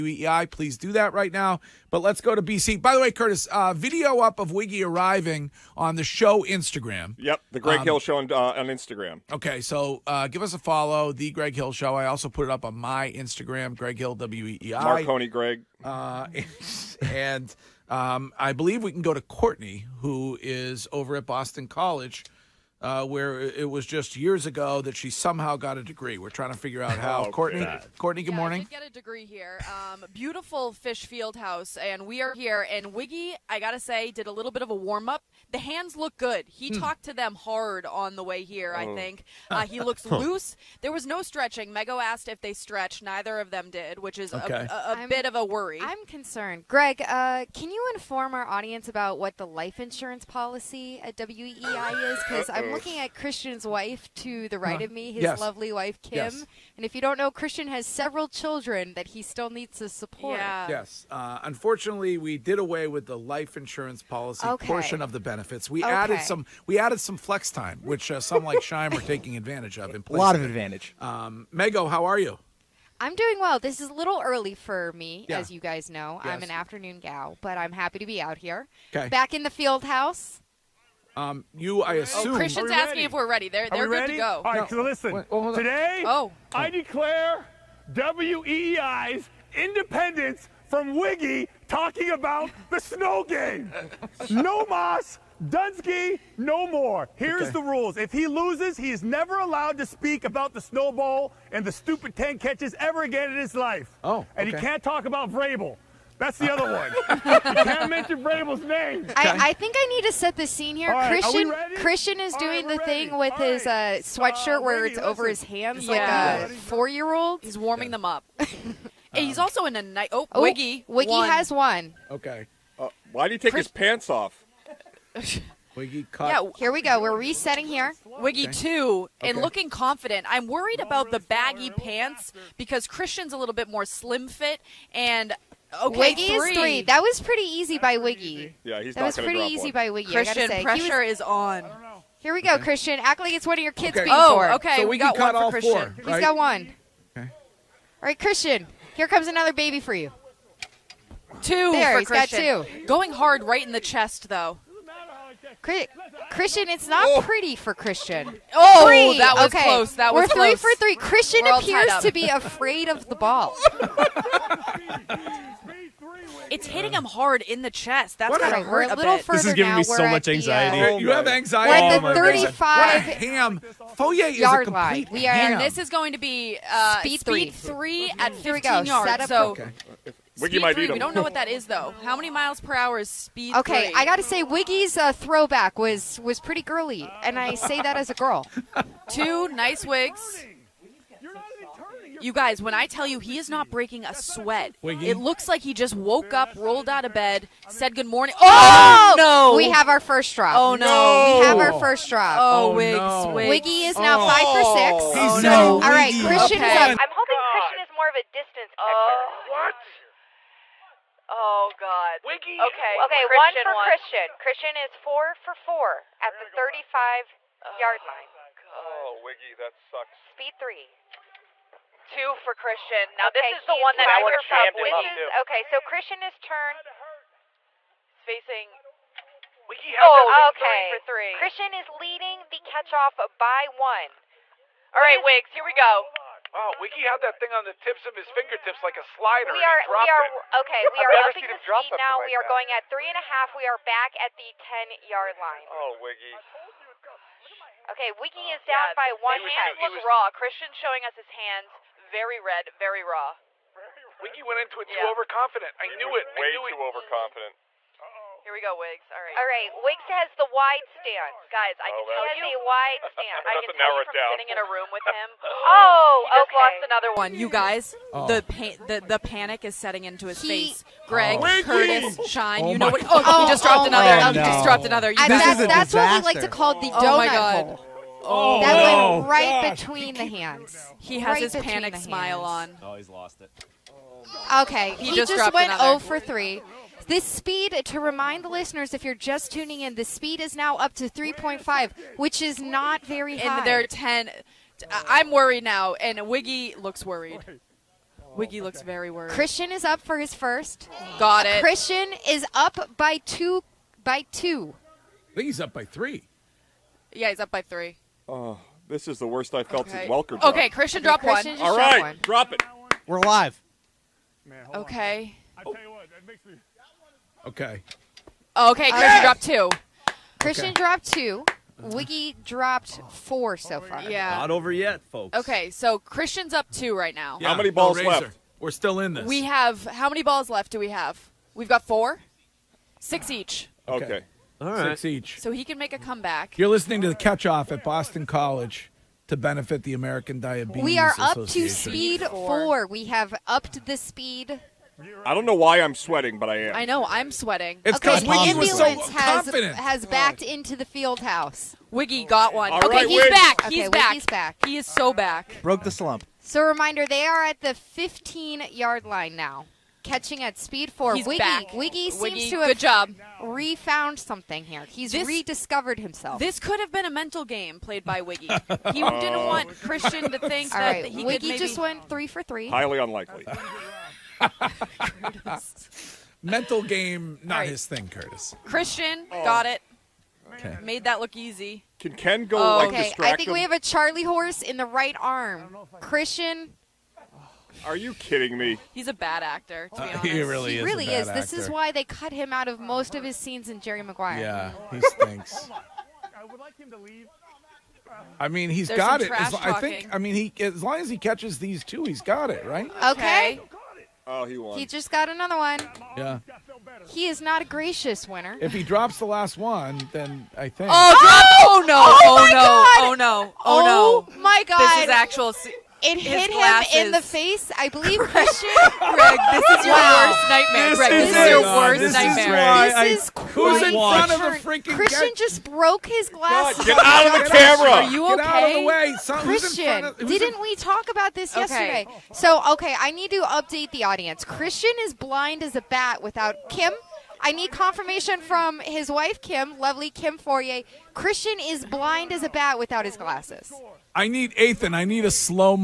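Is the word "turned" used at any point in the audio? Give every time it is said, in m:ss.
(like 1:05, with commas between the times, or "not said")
3:46.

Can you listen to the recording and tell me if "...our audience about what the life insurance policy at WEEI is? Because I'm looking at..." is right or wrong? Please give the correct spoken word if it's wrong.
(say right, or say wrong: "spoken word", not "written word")
right.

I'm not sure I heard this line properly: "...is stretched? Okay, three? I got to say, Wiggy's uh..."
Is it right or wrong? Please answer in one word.
wrong.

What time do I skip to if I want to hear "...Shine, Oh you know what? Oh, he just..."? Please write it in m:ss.
4:32.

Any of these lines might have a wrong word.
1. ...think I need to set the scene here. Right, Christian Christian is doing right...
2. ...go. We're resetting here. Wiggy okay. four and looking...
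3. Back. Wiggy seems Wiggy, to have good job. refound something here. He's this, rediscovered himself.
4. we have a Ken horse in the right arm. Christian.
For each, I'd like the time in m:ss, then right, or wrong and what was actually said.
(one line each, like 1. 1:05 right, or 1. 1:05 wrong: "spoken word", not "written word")
1. 1:49 right
2. 2:06 wrong: "two", not "four"
3. 6:01 right
4. 6:23 wrong: "Charlie", not "Ken".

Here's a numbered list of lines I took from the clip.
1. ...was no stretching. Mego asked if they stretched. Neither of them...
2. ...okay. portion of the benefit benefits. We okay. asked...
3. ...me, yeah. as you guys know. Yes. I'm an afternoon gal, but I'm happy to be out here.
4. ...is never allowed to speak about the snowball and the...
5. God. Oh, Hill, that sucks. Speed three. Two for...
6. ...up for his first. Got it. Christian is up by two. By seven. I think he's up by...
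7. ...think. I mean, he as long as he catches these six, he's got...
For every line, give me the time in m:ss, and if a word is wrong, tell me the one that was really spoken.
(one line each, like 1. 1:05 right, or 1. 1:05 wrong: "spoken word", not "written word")
1. 0:40 right
2. 1:04 wrong: "added", not "asked"
3. 1:14 right
4. 1:38 right
5. 3:38 wrong: "Wiggy", not "Hill"
6. 4:59 wrong: "two", not "seven"
7. 6:39 wrong: "two", not "six".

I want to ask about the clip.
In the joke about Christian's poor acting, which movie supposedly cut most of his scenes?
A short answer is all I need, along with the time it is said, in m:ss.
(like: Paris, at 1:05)
Jerry Maguire, at 6:33.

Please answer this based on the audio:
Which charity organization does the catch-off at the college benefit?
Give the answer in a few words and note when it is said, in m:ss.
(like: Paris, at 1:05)
American Diabetes, at 5:39.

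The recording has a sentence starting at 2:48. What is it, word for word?
That's gonna hurt a, little bit.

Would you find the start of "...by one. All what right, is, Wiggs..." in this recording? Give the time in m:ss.
3:53.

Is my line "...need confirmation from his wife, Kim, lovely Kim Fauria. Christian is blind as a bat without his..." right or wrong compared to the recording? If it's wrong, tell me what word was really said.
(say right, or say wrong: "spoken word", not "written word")
right.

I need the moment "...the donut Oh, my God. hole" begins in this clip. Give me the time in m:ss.
4:36.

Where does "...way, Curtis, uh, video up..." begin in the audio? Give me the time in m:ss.
0:02.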